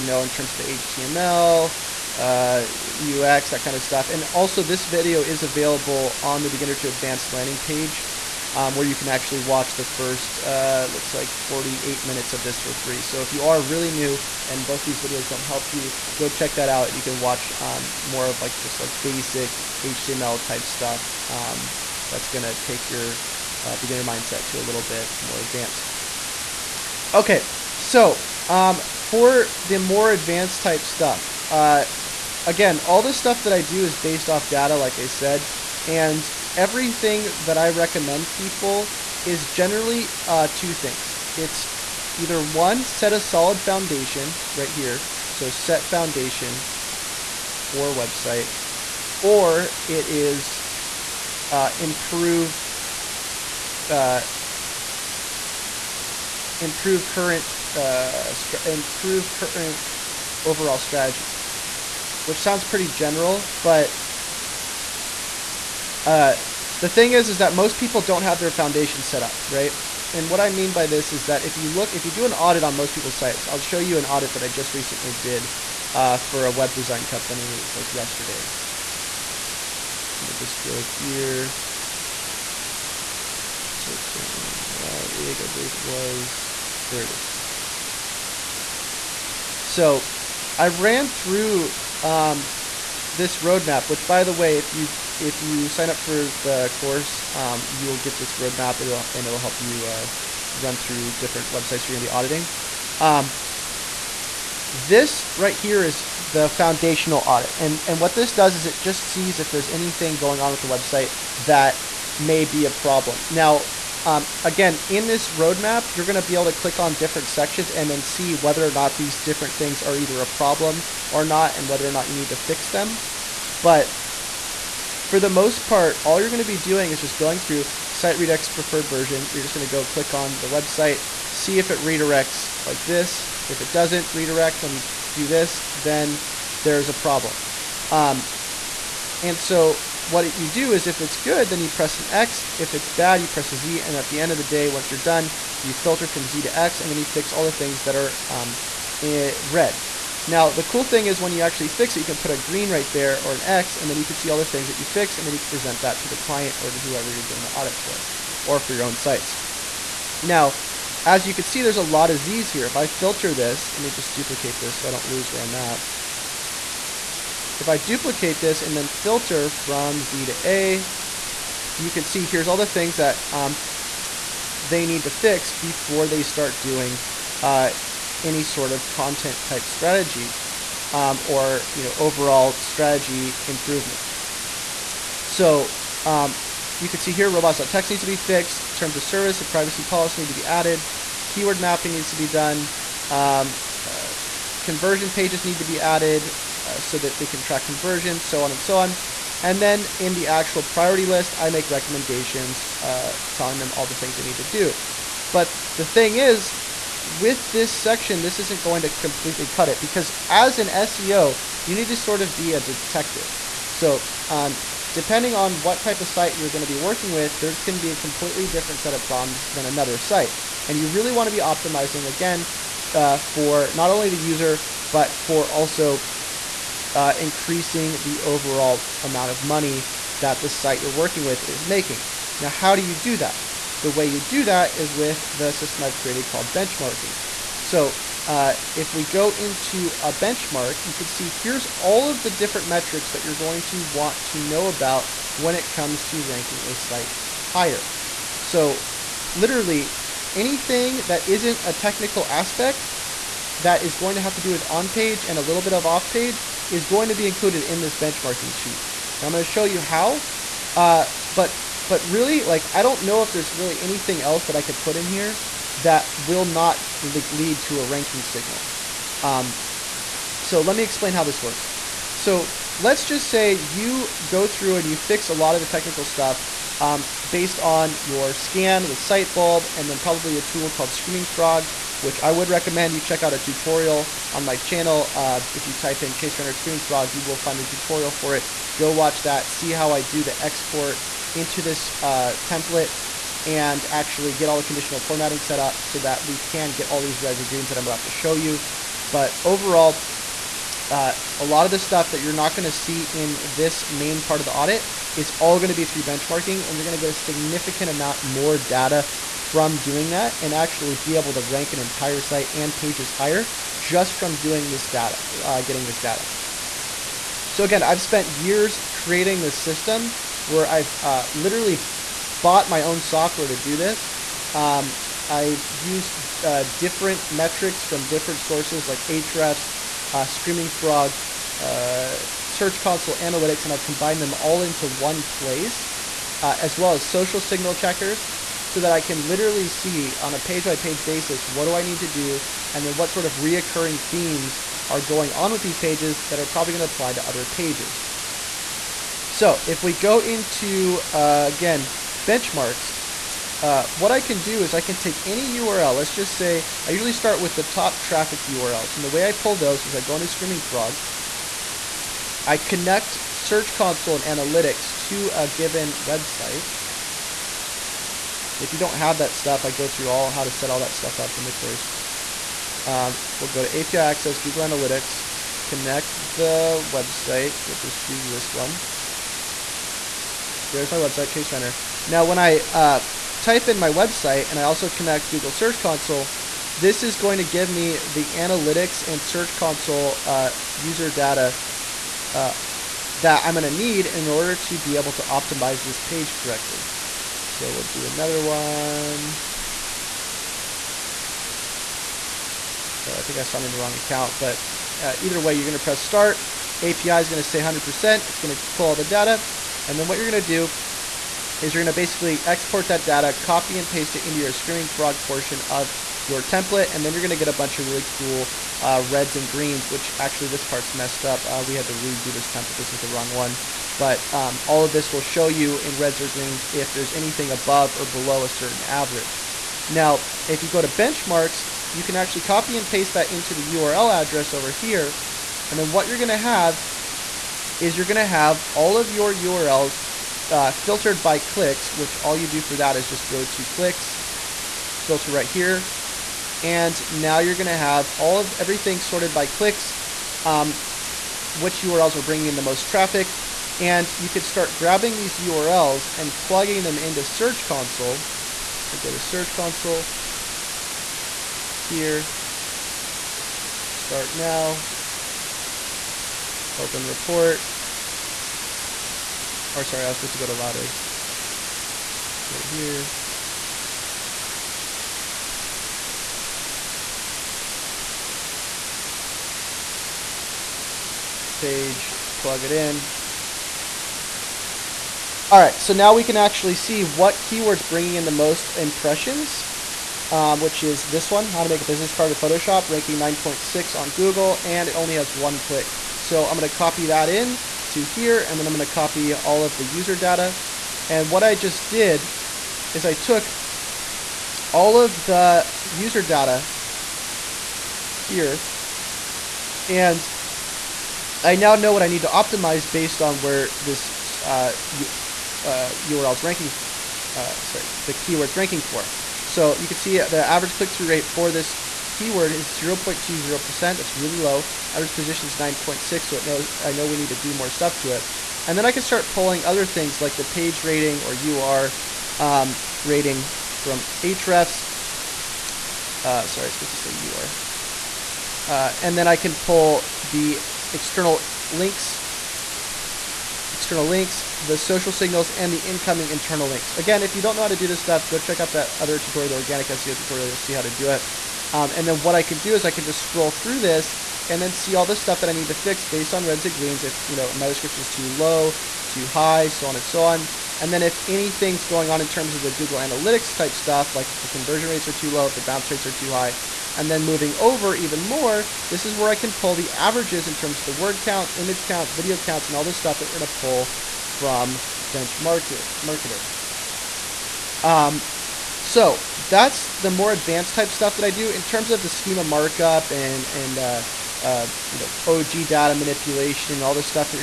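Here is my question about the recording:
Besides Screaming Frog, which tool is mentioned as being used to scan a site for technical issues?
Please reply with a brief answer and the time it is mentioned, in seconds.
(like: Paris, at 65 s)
Sitebulb, at 278 s.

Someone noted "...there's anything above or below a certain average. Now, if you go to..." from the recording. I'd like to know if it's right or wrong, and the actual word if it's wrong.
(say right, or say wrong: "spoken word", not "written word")
right.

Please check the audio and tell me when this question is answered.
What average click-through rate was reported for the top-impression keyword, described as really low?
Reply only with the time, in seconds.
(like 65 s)
522 s.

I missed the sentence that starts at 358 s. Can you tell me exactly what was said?
And the way I pull those is I go into Screaming Frog.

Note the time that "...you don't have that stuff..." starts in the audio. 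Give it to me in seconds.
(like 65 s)
368 s.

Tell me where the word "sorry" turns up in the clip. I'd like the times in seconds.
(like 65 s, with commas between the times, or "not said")
469 s, 517 s, 536 s.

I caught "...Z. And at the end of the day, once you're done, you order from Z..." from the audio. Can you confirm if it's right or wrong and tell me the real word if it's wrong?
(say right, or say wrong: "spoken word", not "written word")
wrong: "filter", not "order".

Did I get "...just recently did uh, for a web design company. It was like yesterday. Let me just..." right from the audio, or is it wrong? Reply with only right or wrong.
right.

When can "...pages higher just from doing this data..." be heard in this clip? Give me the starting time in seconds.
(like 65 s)
312 s.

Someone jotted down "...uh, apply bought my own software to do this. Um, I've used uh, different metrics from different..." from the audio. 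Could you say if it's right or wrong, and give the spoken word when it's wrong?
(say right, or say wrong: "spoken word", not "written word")
wrong: "literally", not "apply".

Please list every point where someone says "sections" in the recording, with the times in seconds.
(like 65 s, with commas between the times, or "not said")
117 s, 207 s.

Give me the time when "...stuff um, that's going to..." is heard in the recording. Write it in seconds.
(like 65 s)
20 s.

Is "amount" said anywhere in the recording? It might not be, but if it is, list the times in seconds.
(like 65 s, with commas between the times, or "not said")
229 s, 307 s.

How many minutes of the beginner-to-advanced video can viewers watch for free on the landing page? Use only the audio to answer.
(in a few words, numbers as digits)
48 minutes.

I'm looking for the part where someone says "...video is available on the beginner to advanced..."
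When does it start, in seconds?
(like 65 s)
4 s.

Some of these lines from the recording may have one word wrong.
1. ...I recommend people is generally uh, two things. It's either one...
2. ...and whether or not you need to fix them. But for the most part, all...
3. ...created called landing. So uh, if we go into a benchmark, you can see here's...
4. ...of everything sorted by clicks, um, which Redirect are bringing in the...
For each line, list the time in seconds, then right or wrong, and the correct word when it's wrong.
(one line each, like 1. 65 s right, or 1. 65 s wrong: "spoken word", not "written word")
1. 37 s right
2. 121 s right
3. 235 s wrong: "benchmarking", not "landing"
4. 448 s wrong: "URLs", not "Redirect".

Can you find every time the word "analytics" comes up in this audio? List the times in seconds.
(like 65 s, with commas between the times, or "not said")
333 s, 364 s, 374 s, 388 s, 562 s.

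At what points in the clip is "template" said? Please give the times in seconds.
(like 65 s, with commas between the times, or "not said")
292 s, 416 s, 422 s.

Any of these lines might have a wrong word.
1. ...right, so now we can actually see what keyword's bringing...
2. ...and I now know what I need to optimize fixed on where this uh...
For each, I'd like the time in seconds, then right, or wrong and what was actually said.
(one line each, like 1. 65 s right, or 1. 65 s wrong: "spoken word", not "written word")
1. 485 s right
2. 509 s wrong: "based", not "fixed".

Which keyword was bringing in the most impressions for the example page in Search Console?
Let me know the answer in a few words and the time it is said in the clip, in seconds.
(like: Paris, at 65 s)
how to make a business card in Photoshop, at 491 s.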